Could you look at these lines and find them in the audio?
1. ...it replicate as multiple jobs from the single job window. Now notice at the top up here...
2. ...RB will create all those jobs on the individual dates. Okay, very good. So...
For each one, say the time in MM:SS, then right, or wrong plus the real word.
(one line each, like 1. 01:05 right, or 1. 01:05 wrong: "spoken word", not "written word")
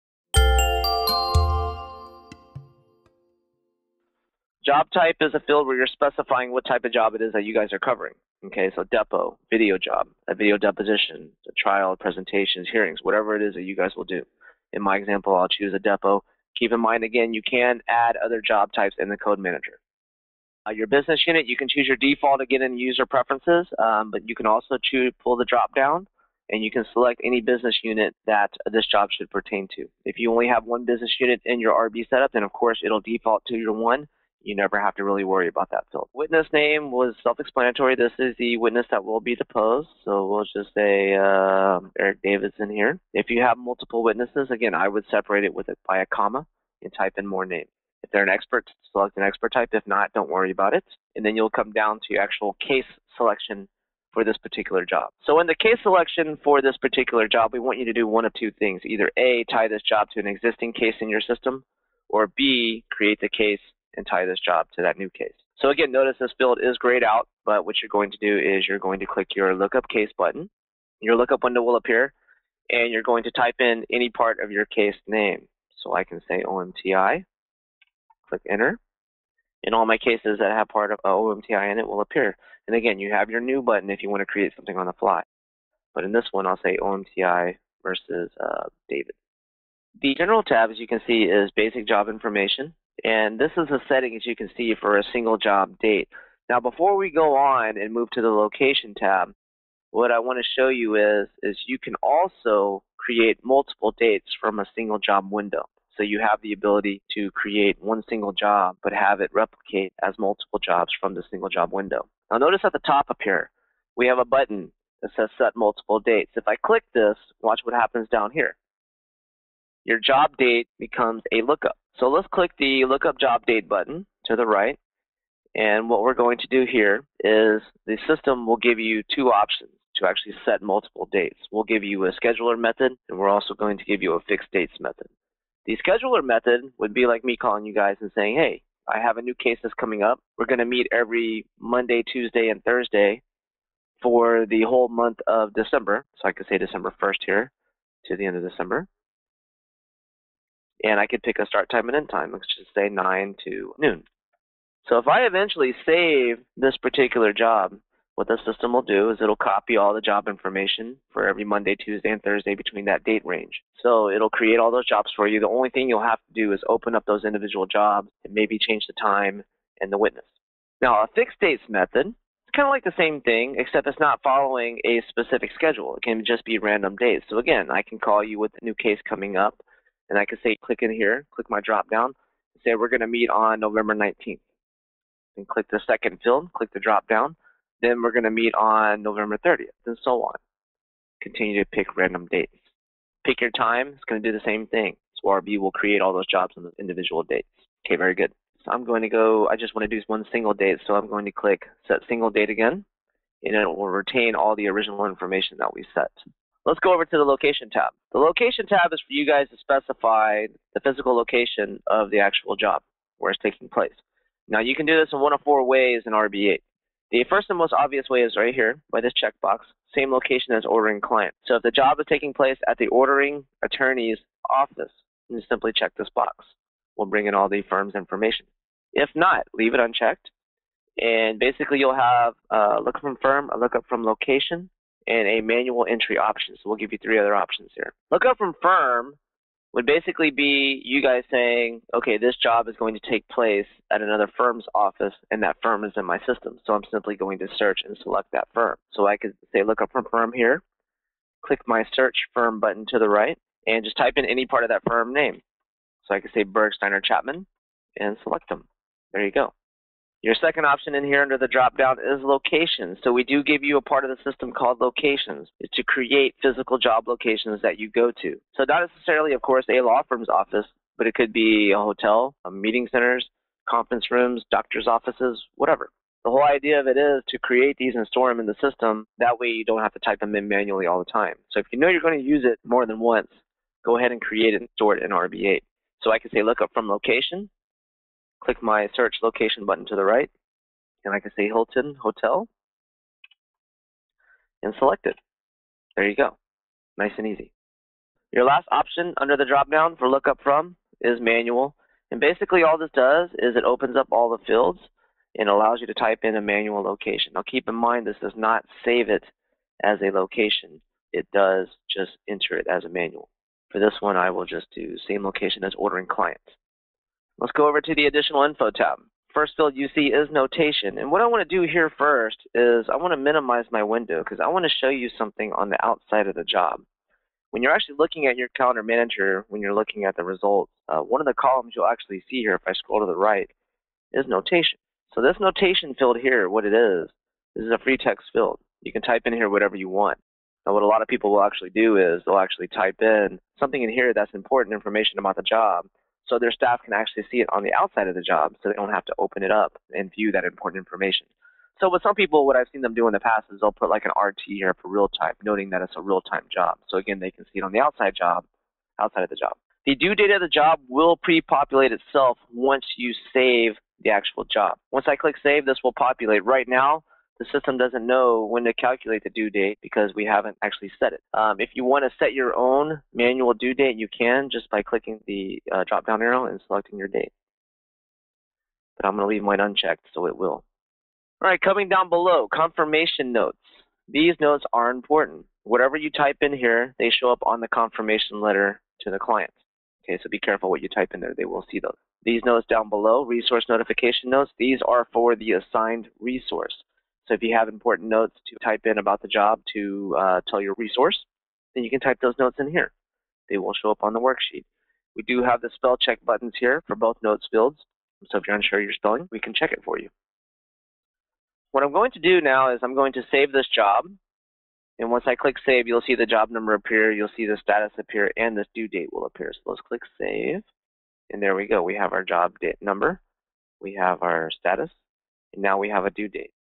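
1. 01:49 right
2. 03:15 right.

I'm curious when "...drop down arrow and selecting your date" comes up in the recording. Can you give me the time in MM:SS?
06:15.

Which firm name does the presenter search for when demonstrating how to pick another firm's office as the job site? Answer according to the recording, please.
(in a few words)
Bergsteiner Chapman.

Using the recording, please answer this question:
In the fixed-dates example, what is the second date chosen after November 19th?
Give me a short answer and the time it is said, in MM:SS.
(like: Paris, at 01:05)
November 30th, at 03:09.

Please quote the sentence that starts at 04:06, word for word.
So I'm simply going to search and select that firm.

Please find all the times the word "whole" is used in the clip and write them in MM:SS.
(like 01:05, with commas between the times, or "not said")
02:24, 04:36.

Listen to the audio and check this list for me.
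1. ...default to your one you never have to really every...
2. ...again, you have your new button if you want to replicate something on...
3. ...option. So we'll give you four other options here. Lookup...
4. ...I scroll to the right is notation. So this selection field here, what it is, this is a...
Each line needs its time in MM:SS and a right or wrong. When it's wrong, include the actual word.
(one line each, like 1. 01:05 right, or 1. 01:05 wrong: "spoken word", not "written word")
1. 00:33 wrong: "worry", not "every"
2. 01:22 wrong: "create", not "replicate"
3. 03:56 wrong: "three", not "four"
4. 05:32 wrong: "notation", not "selection".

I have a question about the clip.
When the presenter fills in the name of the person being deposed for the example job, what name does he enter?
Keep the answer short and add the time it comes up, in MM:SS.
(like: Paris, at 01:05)
Eric, at 00:41.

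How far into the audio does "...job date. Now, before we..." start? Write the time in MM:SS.
01:35.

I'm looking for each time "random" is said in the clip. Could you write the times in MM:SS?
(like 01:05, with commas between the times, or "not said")
02:56, 03:11.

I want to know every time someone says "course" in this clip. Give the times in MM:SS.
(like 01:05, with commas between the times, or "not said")
00:32, 04:29.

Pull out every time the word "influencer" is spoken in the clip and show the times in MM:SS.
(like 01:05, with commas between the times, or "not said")
not said.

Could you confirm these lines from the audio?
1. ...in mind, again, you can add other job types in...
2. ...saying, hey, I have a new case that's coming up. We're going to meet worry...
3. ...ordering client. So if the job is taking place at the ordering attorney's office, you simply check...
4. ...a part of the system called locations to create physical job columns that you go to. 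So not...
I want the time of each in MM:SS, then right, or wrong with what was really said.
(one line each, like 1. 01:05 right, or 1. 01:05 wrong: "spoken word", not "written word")
1. 00:16 right
2. 02:18 wrong: "every", not "worry"
3. 03:40 right
4. 04:23 wrong: "locations", not "columns".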